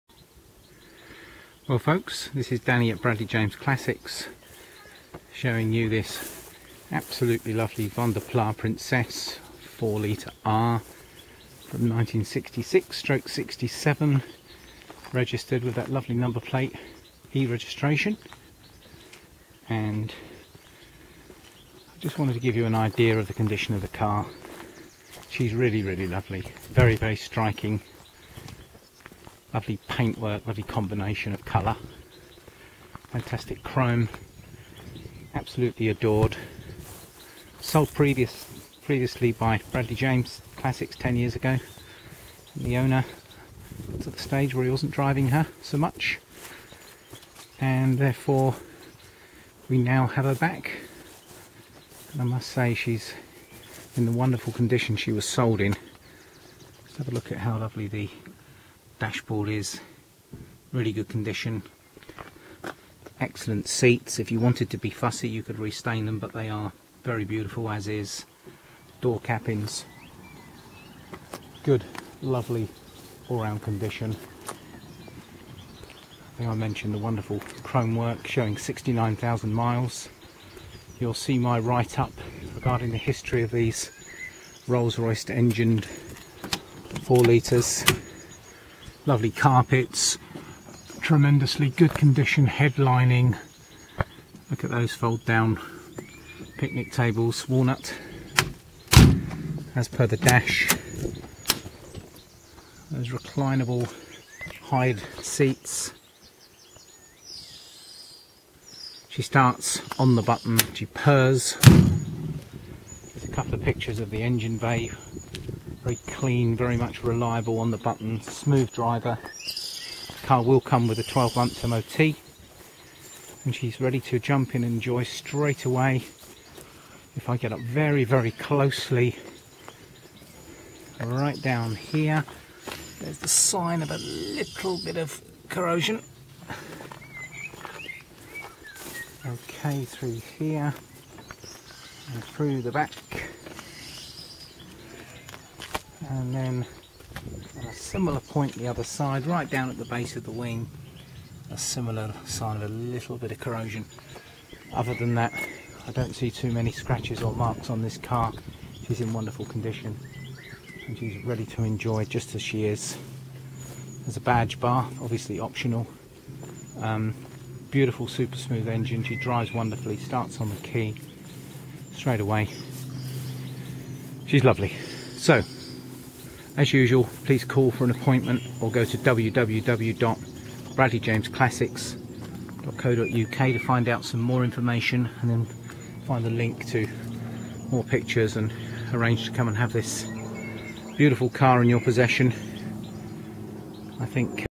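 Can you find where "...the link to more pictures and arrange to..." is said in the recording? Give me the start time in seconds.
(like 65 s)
186 s.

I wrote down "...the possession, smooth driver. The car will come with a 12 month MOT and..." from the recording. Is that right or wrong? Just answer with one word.
wrong.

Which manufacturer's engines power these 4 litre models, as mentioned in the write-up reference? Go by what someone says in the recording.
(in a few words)
Rolls-Royce.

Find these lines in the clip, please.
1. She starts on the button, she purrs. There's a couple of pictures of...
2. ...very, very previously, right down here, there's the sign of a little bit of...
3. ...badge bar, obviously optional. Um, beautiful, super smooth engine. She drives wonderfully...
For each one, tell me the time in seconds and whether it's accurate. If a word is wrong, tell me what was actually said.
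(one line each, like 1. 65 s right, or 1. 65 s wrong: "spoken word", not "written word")
1. 109 s right
2. 127 s wrong: "closely", not "previously"
3. 164 s right.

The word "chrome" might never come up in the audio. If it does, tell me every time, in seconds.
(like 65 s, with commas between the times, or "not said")
33 s, 77 s.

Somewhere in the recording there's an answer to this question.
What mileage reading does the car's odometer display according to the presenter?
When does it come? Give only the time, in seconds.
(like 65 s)
78 s.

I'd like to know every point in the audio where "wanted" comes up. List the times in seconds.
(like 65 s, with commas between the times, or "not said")
22 s, 64 s.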